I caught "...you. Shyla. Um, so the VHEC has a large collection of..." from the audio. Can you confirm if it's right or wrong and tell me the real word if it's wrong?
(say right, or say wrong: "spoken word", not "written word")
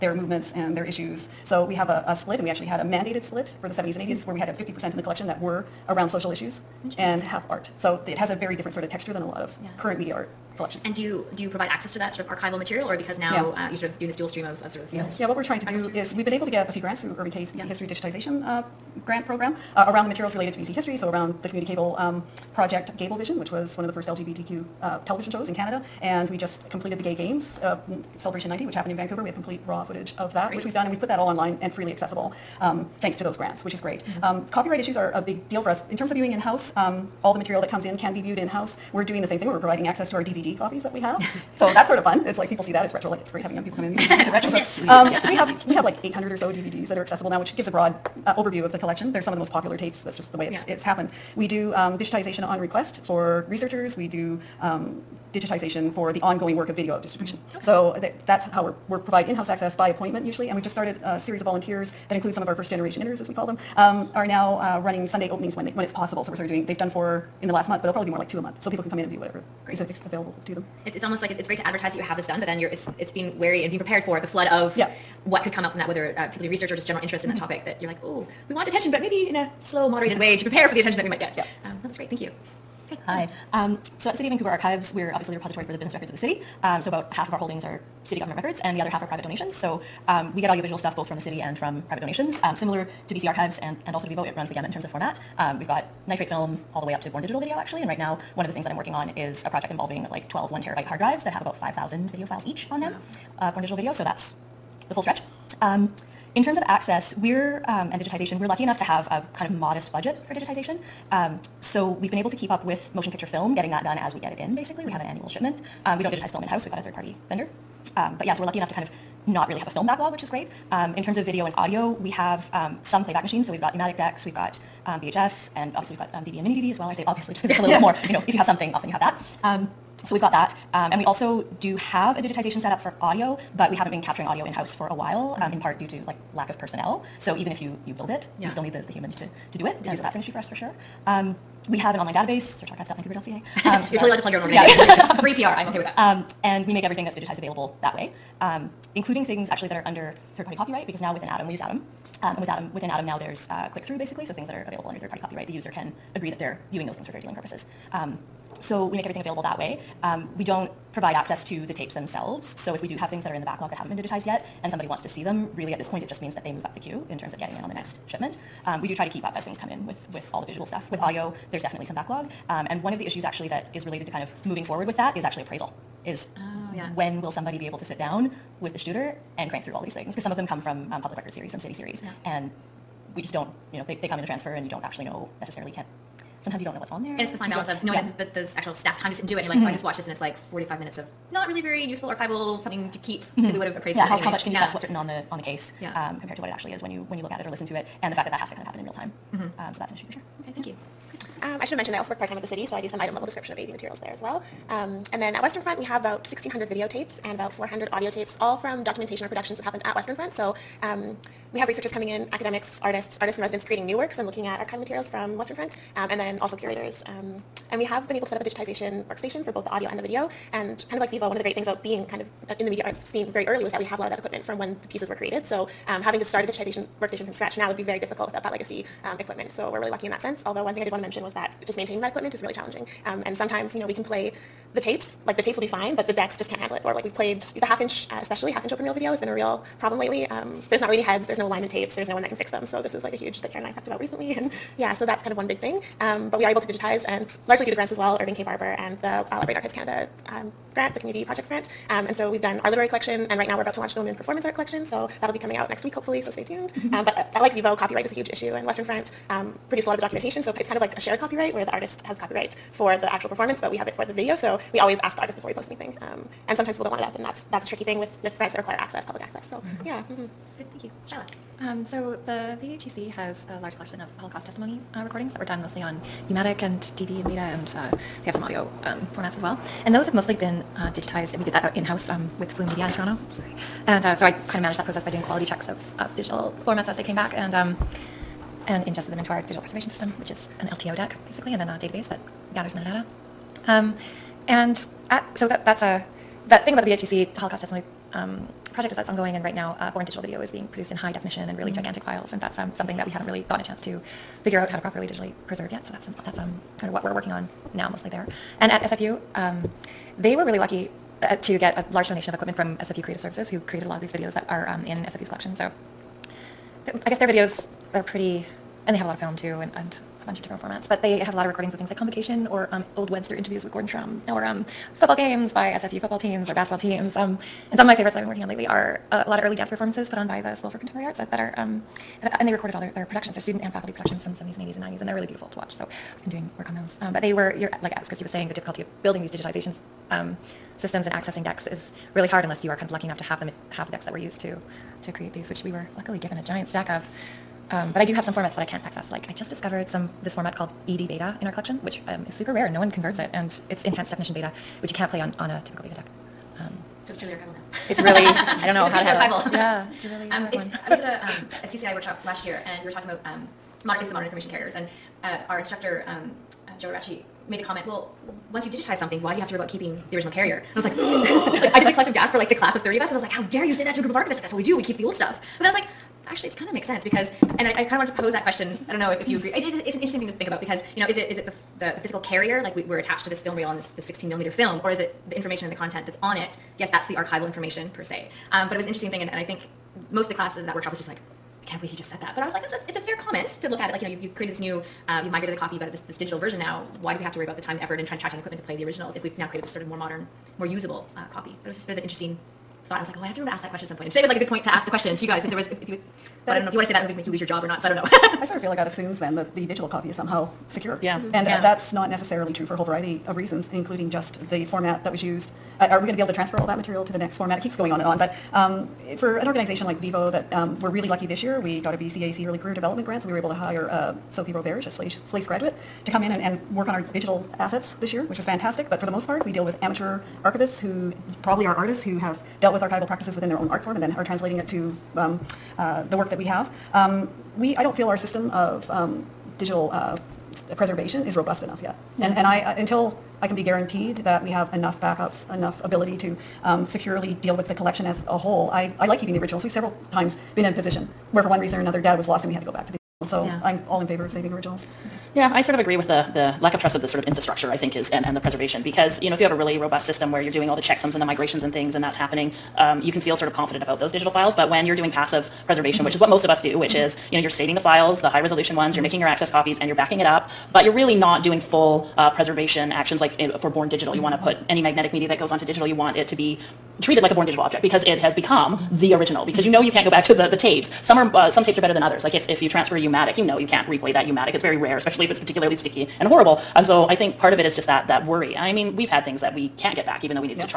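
right.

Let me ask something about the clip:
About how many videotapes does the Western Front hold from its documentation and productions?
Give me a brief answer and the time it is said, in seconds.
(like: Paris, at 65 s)
1,600, at 206 s.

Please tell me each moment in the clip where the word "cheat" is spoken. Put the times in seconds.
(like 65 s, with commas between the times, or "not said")
not said.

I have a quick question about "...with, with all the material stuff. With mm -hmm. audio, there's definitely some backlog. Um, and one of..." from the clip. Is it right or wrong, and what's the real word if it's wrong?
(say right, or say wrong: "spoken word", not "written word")
wrong: "visual", not "material".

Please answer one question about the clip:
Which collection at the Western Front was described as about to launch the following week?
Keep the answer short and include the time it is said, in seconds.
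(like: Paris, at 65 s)
Women in Performance Art, at 253 s.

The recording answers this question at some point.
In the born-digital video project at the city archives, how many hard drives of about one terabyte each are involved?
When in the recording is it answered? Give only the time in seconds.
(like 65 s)
100 s.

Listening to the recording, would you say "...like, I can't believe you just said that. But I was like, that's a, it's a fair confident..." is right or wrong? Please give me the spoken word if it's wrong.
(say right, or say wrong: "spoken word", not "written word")
wrong: "comment", not "confident".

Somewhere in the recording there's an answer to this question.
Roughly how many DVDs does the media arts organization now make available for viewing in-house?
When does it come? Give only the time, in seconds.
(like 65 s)
46 s.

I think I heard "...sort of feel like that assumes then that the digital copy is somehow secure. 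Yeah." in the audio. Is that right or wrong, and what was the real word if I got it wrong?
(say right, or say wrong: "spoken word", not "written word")
right.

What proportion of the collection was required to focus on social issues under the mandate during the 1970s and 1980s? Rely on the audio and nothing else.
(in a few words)
50%.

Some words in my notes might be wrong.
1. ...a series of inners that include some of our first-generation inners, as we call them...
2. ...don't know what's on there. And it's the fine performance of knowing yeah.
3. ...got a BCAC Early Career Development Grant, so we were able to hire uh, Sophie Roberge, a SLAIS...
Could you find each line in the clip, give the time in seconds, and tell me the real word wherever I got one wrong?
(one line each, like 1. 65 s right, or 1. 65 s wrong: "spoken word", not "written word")
1. 61 s wrong: "volunteers", not "inners"
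2. 186 s wrong: "balance", not "performance"
3. 421 s right.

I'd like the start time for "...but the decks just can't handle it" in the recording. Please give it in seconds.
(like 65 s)
235 s.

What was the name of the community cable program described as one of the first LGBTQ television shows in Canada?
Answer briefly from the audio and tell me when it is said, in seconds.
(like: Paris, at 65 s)
Gayblevision, at 22 s.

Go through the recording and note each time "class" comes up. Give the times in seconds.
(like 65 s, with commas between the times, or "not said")
372 s, 390 s.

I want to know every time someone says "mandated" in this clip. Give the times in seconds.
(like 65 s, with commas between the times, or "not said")
2 s.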